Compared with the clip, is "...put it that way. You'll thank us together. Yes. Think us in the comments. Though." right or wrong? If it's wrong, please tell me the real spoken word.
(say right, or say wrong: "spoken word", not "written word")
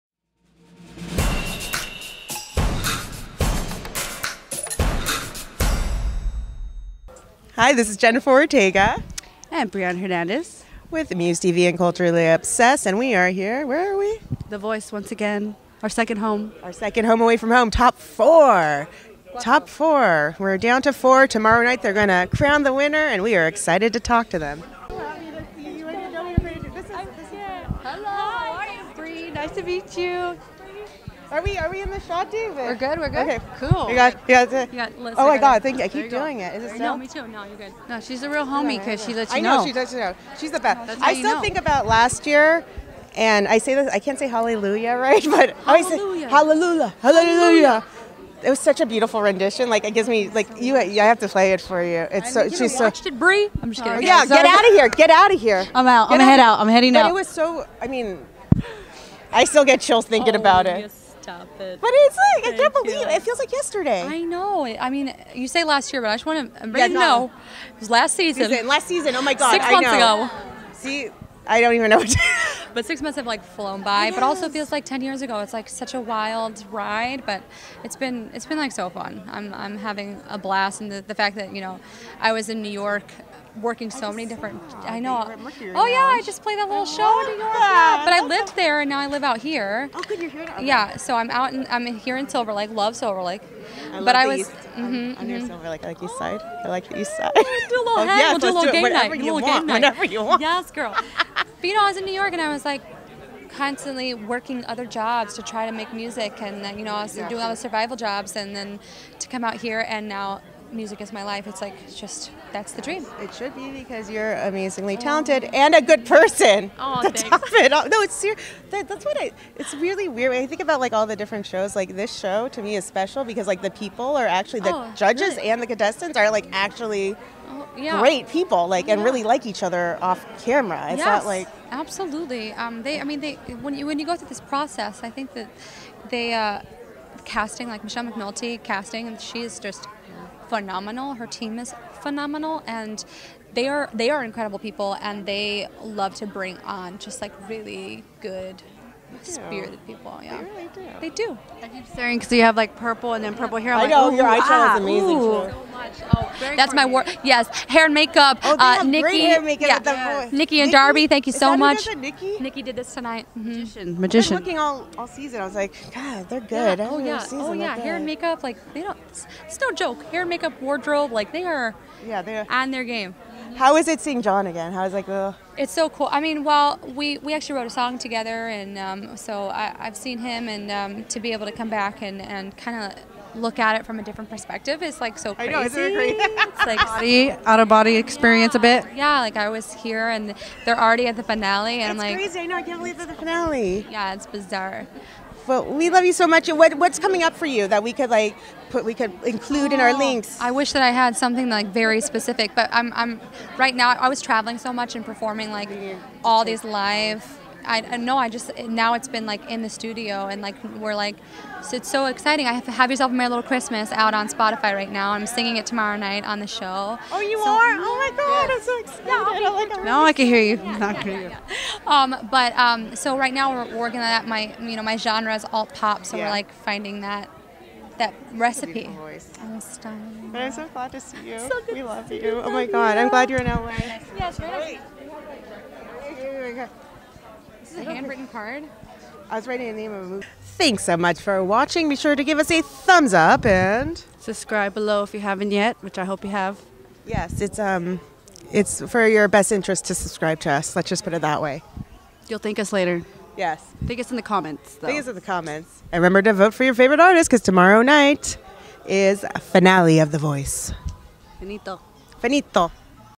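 wrong: "later", not "together".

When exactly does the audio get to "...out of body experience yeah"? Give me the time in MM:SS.
03:07.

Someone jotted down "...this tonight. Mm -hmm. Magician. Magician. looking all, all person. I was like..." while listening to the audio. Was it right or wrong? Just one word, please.
wrong.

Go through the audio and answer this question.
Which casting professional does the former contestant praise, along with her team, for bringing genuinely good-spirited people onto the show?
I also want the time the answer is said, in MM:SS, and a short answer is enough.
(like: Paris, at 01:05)
Michelle McNulty, at 02:17.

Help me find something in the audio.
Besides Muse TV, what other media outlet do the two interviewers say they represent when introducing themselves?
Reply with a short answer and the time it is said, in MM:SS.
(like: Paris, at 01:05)
Culturally Obsessed, at 00:11.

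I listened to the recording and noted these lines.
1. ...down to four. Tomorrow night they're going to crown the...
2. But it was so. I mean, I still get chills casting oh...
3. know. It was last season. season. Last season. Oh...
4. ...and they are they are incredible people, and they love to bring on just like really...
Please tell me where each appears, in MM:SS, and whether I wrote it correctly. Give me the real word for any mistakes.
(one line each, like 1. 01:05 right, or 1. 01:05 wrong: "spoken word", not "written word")
1. 00:20 right
2. 00:57 wrong: "thinking", not "casting"
3. 01:06 right
4. 02:22 right.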